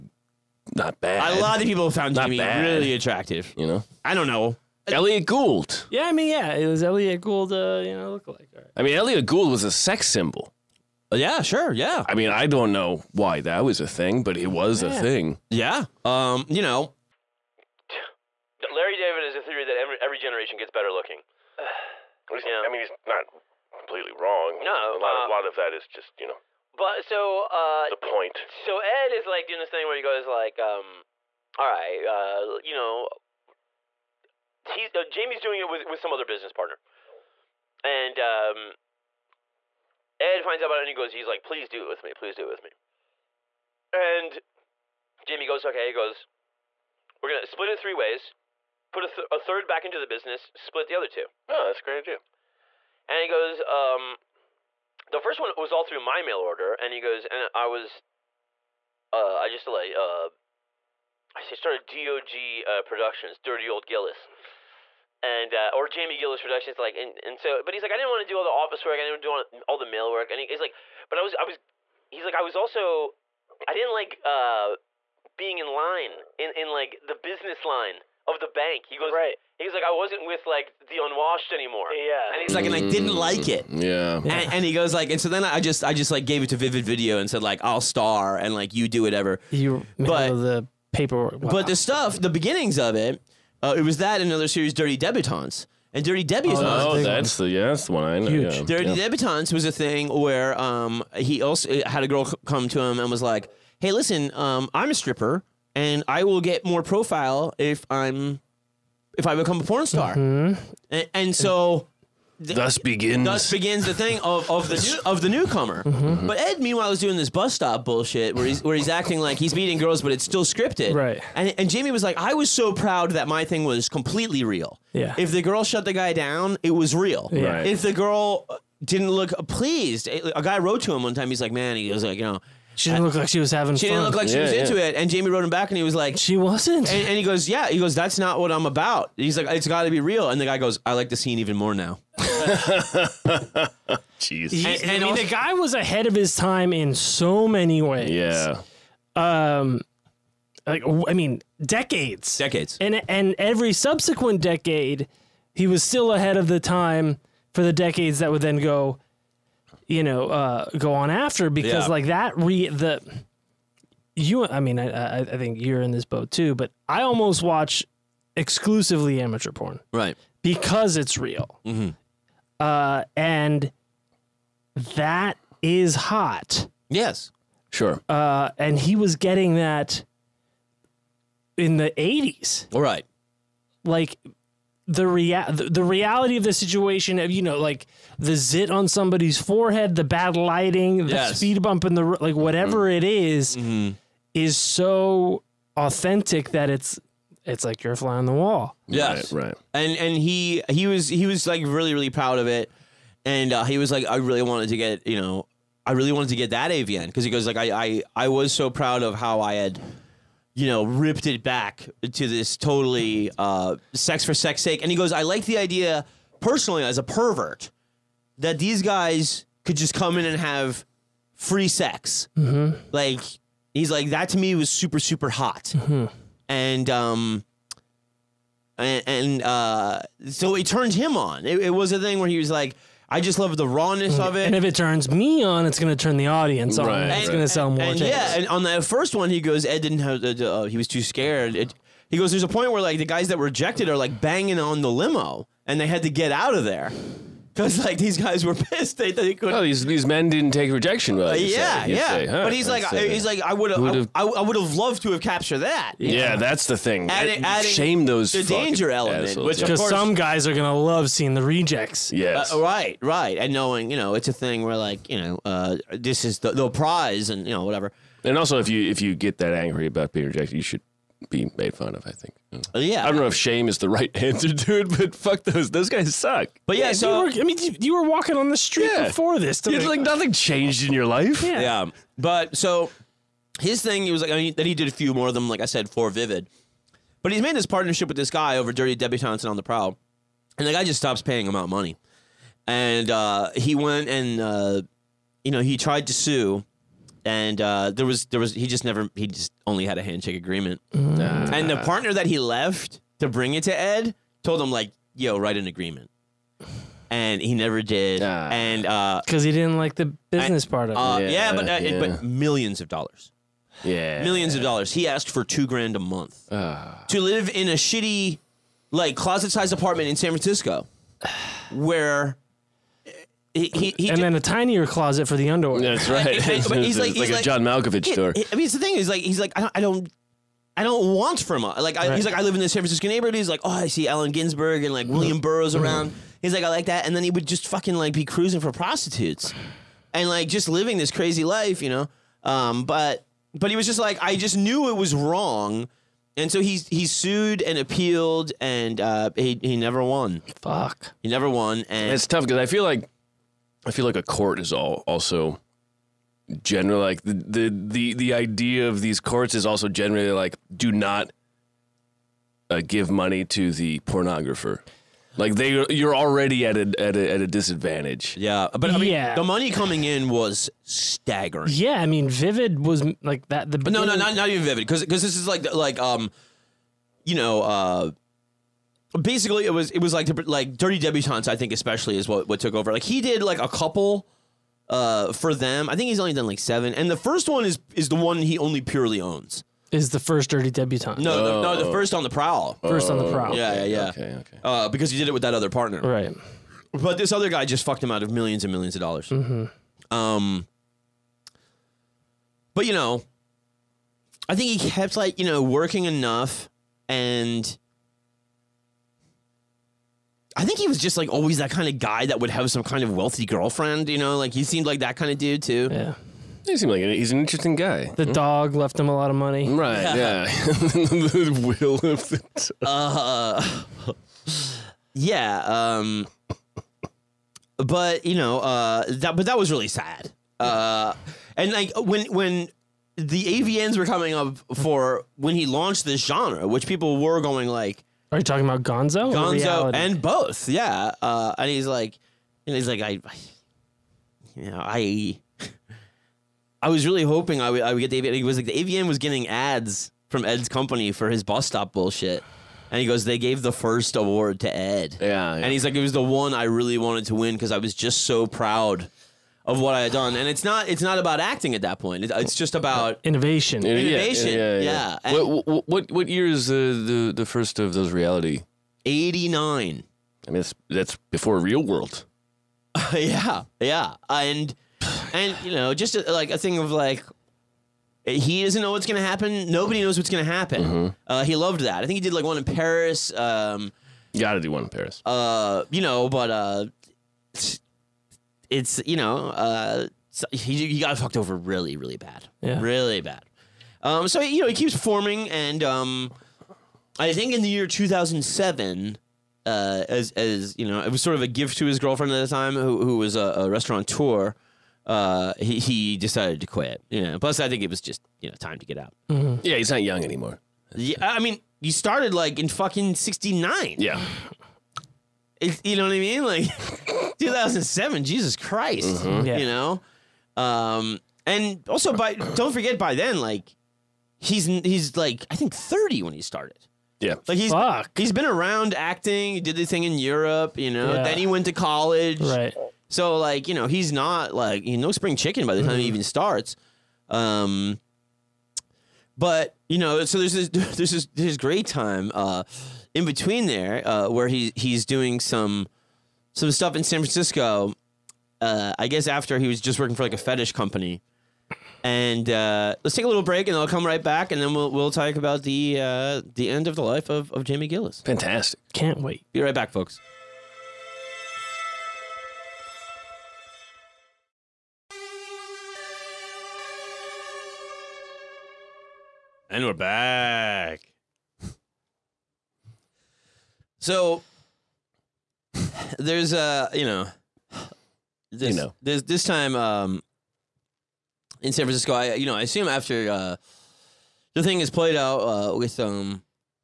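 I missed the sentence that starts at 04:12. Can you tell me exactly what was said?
Say, huh, but he's like, he's like, I would have, I, I would have loved to have captured that.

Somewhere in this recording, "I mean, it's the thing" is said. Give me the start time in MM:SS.
05:28.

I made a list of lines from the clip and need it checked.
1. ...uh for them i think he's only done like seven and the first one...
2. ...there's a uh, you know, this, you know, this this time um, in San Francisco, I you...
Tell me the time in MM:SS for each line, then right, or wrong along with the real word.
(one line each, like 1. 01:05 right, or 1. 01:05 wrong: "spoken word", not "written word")
1. 06:24 right
2. 09:36 right.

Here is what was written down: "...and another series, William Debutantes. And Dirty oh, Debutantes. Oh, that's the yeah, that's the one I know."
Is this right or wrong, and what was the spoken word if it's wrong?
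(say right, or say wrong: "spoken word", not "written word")
wrong: "Dirty", not "William".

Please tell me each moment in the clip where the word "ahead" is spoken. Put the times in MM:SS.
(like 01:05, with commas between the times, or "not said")
02:25, 02:36.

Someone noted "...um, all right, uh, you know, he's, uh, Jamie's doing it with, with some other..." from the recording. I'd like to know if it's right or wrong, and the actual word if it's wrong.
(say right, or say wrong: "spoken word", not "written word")
right.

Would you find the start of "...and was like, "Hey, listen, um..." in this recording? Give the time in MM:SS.
01:42.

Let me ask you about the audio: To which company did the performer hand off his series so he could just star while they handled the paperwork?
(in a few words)
Vivid Video.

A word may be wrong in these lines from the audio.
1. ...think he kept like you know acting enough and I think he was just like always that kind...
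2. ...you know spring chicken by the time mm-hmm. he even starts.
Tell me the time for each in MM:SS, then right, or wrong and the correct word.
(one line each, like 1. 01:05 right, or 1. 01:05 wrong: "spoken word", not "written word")
1. 06:44 wrong: "working", not "acting"
2. 08:54 right.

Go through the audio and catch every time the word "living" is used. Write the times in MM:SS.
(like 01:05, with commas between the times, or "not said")
05:40.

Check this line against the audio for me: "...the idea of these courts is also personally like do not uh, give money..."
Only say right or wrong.
wrong.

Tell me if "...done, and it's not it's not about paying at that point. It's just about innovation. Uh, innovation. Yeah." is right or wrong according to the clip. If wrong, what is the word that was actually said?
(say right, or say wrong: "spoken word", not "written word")
wrong: "acting", not "paying".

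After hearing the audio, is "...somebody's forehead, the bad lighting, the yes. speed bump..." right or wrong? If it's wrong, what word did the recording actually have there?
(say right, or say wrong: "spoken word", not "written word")
right.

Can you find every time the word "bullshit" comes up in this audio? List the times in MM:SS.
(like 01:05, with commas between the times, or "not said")
01:57, 07:31.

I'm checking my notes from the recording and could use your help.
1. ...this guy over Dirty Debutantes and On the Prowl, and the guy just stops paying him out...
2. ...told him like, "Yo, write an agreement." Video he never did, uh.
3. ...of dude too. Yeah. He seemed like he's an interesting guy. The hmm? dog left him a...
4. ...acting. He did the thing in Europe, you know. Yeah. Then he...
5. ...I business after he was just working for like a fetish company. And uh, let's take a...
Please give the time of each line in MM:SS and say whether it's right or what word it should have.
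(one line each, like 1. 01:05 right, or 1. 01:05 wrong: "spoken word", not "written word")
1. 04:48 right
2. 05:04 wrong: "And", not "Video"
3. 06:55 right
4. 08:48 right
5. 09:08 wrong: "guess", not "business".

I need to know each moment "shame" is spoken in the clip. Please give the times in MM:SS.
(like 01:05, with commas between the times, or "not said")
04:17, 04:33.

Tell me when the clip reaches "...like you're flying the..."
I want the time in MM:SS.
03:17.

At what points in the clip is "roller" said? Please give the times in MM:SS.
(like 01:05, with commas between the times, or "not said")
not said.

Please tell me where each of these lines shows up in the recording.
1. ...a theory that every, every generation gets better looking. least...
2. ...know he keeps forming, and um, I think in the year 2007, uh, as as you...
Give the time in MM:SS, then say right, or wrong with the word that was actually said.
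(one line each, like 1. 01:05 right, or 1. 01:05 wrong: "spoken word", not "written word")
1. 00:19 right
2. 08:14 right.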